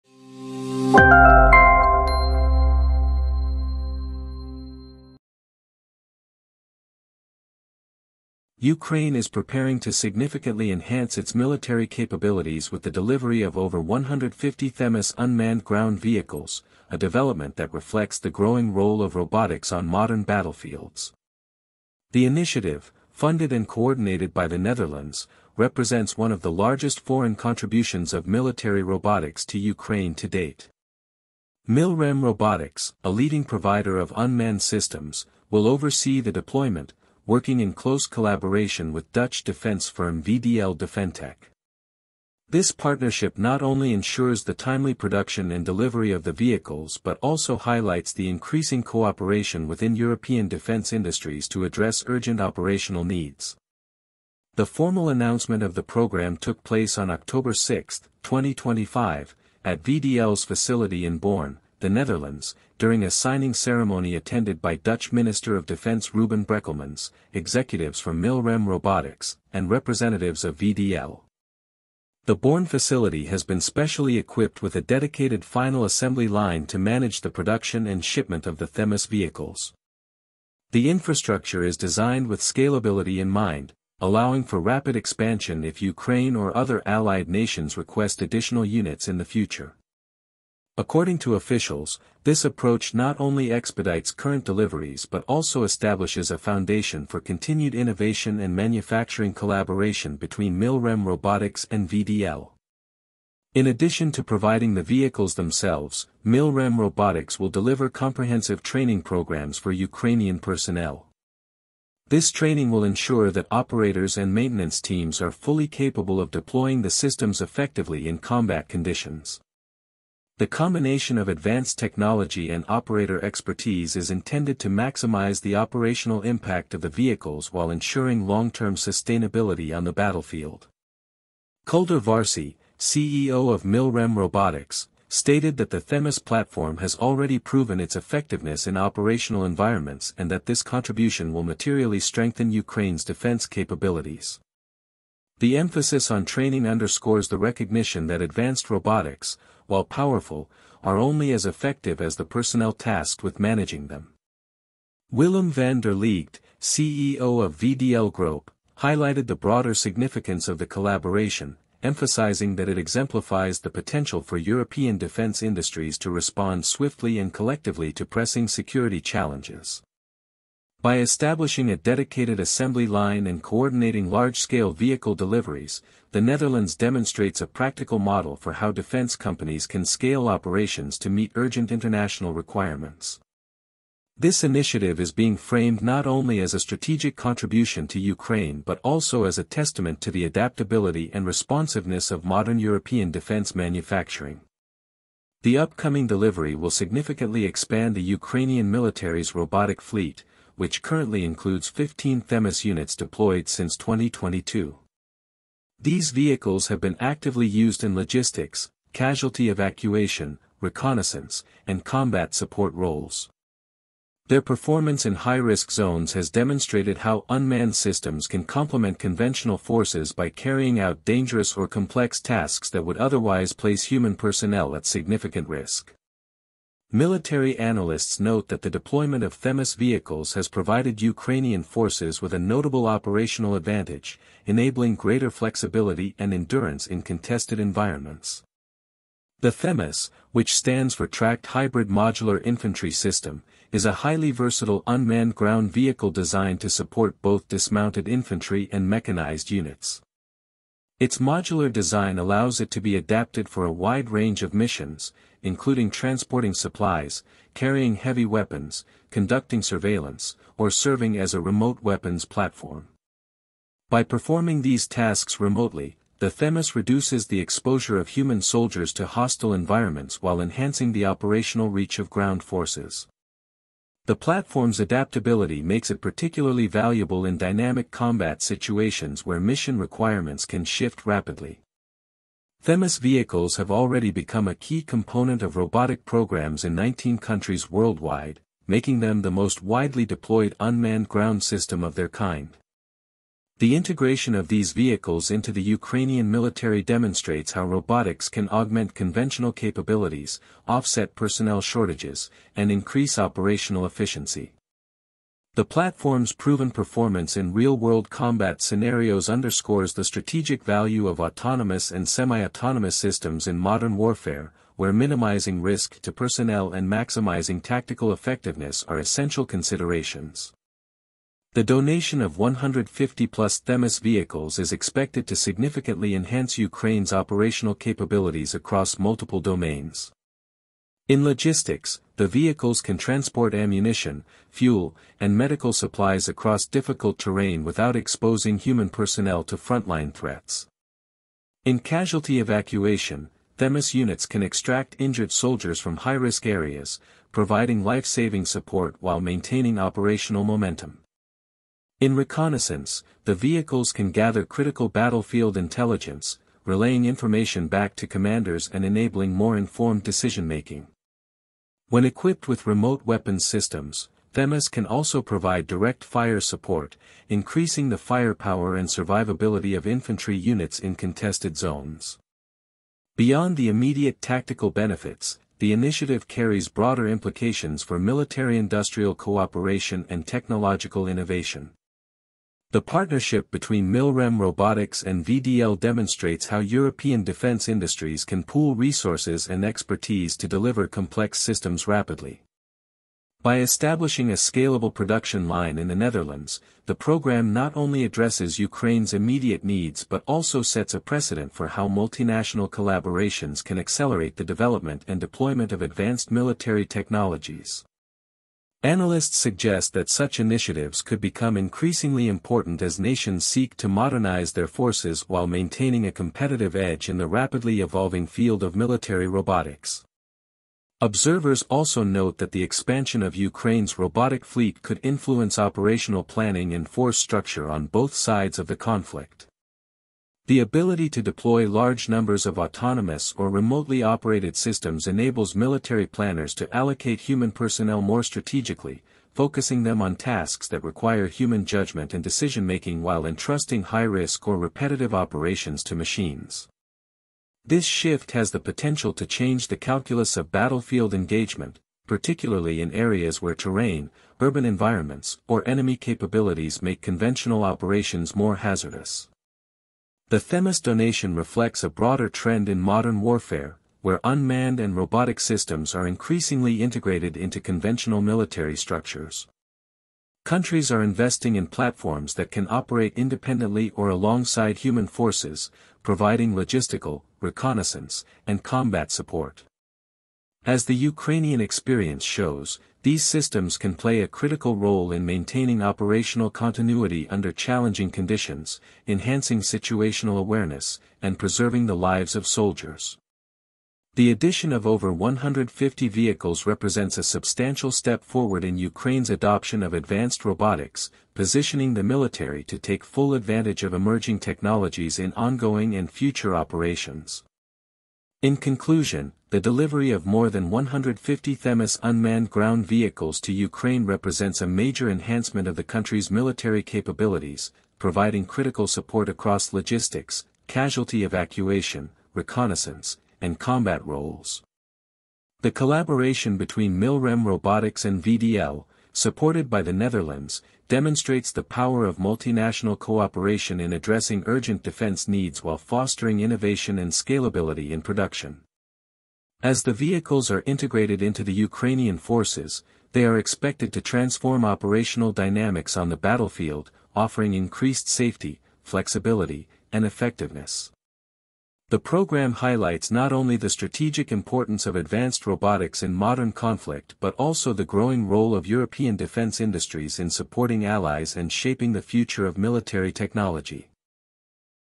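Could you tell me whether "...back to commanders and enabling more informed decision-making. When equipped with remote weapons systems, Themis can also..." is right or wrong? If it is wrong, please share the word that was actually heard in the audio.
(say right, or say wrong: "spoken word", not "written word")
right.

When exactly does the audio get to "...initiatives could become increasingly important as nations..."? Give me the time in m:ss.
6:50.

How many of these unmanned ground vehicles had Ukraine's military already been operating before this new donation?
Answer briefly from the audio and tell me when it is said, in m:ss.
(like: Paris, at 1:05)
15, at 3:21.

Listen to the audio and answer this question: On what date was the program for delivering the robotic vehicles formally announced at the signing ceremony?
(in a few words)
October 6, 2025.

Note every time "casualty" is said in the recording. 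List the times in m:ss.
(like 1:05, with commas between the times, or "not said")
3:28, 5:41, 8:40.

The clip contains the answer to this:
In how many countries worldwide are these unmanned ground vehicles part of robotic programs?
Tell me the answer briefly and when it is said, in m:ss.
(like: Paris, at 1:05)
19, at 4:46.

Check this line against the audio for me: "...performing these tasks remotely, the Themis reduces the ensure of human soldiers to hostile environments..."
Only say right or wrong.
wrong.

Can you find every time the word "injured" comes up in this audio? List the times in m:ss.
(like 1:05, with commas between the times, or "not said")
5:44.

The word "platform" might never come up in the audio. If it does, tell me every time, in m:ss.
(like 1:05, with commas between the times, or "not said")
2:16, 4:22, 4:34, 5:05, 7:51.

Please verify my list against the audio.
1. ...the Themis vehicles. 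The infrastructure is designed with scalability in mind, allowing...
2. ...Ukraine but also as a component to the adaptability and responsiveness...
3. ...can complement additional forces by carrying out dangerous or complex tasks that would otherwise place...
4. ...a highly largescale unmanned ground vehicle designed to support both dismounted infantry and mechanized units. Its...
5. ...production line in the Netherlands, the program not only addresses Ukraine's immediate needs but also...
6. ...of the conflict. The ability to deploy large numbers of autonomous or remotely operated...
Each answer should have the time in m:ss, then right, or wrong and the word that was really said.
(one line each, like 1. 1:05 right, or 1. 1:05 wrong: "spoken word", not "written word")
1. 1:18 right
2. 3:07 wrong: "testament", not "component"
3. 3:38 wrong: "conventional", not "additional"
4. 4:03 wrong: "versatile", not "largescale"
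5. 6:34 right
6. 7:08 right.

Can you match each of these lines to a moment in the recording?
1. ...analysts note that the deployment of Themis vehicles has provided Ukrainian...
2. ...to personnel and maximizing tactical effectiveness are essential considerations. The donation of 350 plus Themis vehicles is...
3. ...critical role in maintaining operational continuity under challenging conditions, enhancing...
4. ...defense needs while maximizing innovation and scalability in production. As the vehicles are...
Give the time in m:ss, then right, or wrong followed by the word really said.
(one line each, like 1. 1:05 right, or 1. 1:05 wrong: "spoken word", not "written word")
1. 3:47 right
2. 5:16 wrong: "150", not "350"
3. 8:04 right
4. 8:54 wrong: "fostering", not "maximizing".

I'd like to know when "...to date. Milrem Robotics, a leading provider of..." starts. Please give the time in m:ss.
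0:30.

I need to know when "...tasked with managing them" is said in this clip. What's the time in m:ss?
2:32.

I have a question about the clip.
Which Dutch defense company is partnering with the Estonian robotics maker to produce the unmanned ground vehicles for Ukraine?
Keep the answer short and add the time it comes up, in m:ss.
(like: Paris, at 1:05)
VDL Defentec, at 0:40.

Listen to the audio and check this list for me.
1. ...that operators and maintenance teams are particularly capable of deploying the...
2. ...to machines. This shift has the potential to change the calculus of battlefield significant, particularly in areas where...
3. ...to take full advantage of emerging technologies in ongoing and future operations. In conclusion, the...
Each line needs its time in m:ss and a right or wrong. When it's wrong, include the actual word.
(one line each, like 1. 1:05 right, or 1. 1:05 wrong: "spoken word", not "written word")
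1. 1:53 wrong: "fully", not "particularly"
2. 7:25 wrong: "engagement", not "significant"
3. 8:22 right.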